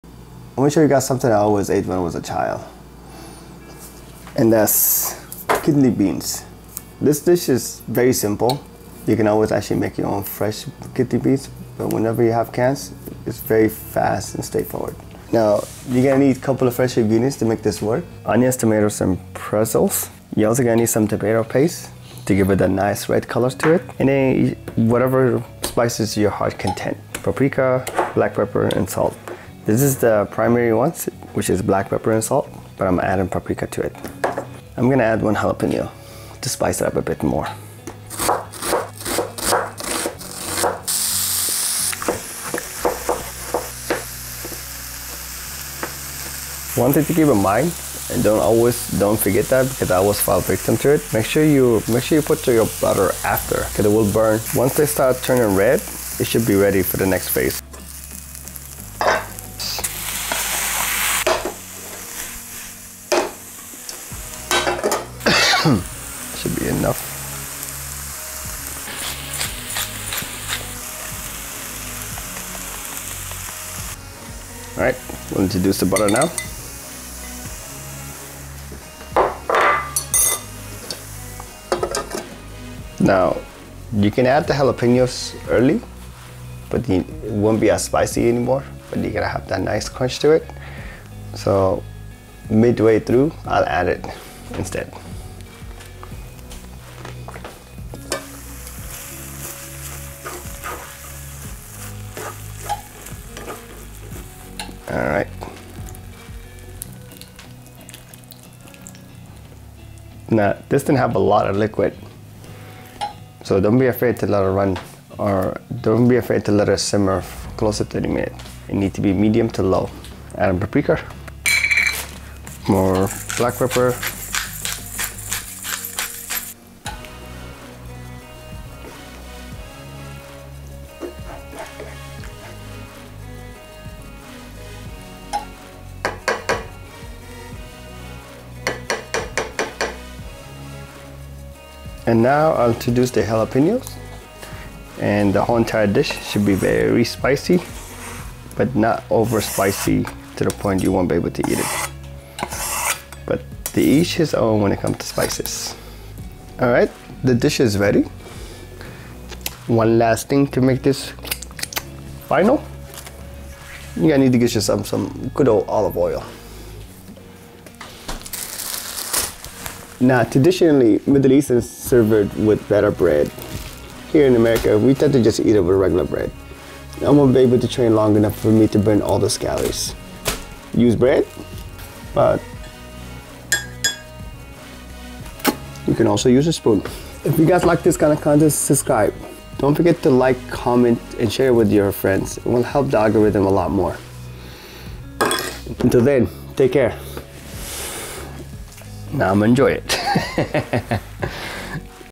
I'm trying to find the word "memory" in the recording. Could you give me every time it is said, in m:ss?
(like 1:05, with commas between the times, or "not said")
not said.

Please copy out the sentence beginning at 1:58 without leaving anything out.
It needs to be medium to low.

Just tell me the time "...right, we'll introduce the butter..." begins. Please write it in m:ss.
1:14.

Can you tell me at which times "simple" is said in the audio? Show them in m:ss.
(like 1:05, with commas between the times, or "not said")
0:08.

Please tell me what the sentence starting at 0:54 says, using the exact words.
Once they start turning red, it should be ready for the next phase.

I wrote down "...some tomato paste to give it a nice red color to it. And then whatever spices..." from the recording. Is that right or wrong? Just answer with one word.
right.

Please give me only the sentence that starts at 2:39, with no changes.
One last thing to make this final.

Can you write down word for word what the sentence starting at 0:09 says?
You can always actually make your own fresh kidney beans, but whenever you have cans, it's very fast and straightforward.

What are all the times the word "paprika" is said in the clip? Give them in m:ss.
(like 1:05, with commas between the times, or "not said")
0:27, 0:33, 2:00.